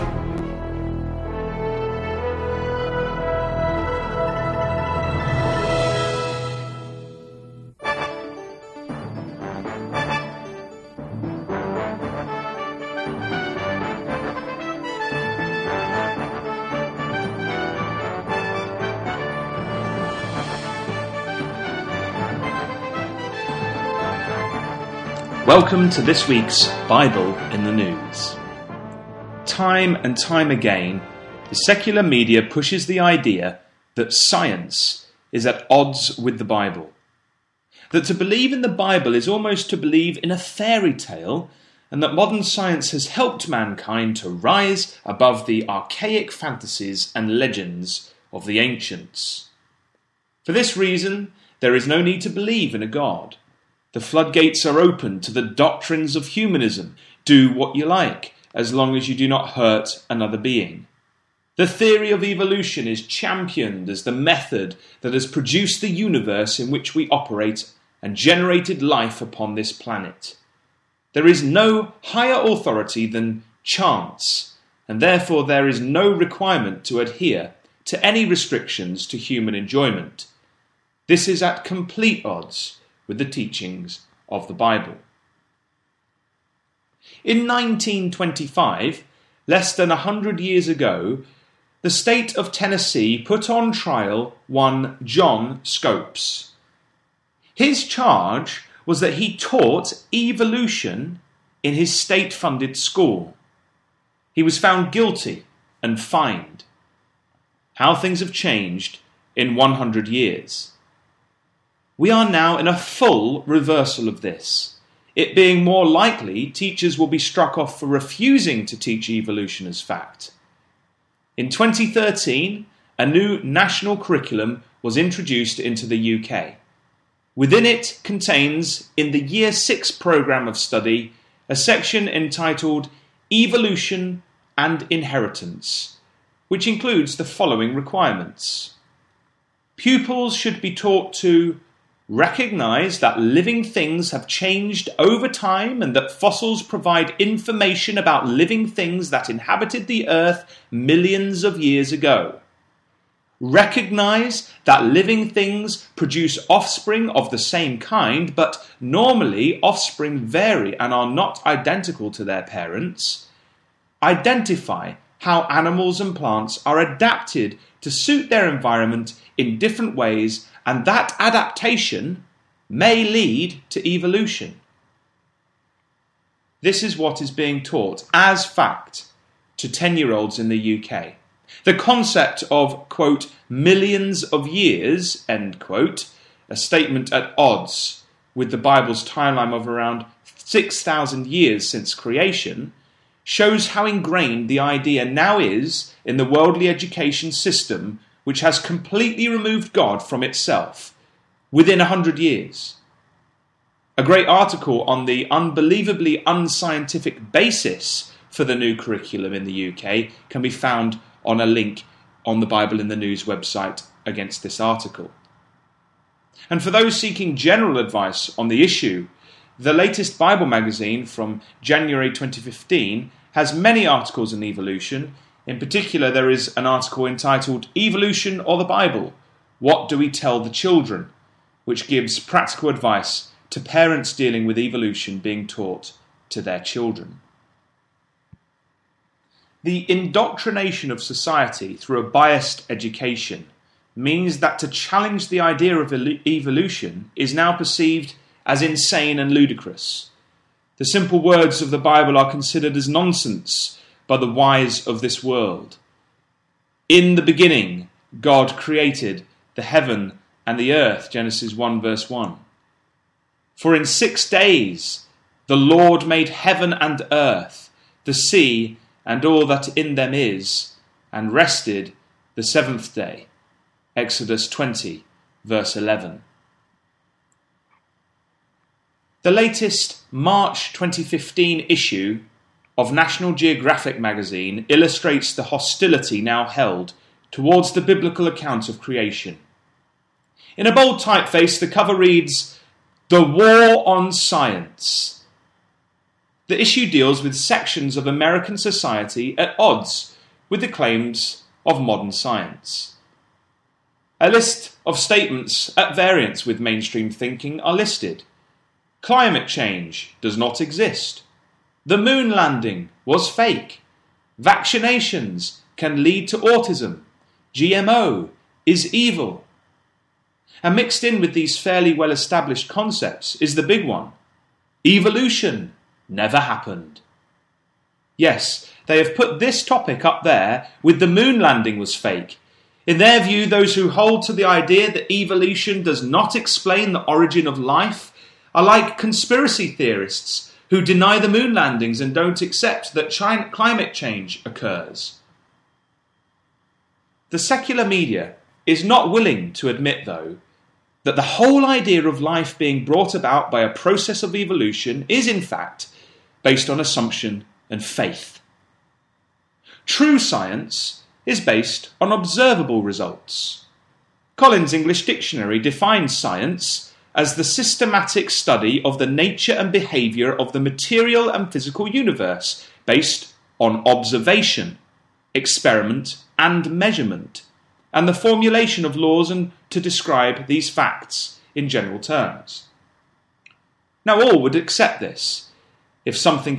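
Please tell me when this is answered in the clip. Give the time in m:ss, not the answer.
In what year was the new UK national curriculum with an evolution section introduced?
2:01.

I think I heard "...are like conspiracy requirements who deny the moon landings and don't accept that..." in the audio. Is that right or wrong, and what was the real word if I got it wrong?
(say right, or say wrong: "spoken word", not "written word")
wrong: "theorists", not "requirements".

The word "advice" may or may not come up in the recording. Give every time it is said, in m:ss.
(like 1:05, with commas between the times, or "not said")
3:37, 3:52.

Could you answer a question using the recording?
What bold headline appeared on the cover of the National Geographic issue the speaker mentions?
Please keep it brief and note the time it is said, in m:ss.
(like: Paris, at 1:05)
The War on Science, at 4:53.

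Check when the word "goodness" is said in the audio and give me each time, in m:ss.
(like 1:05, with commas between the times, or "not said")
not said.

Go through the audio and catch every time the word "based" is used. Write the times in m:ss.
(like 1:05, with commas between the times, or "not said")
5:56, 6:01, 6:12.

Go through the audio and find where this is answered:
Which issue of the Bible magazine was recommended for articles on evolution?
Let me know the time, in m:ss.
3:41.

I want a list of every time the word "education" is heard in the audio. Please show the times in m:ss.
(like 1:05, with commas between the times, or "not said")
3:16, 4:02.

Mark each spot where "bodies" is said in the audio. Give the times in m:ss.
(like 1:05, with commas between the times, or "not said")
not said.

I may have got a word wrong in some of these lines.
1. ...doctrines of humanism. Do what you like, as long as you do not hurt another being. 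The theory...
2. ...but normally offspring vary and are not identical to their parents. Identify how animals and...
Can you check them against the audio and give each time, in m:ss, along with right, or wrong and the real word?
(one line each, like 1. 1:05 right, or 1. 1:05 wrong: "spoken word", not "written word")
1. 0:55 right
2. 2:38 right.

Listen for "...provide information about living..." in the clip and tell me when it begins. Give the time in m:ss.
2:26.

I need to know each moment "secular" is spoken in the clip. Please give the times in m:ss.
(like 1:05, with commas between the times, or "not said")
0:31, 5:47.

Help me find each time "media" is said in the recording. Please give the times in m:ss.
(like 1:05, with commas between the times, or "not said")
0:32, 5:47.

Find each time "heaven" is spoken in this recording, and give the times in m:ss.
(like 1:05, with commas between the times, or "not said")
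4:19, 4:26.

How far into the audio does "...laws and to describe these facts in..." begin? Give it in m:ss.
6:18.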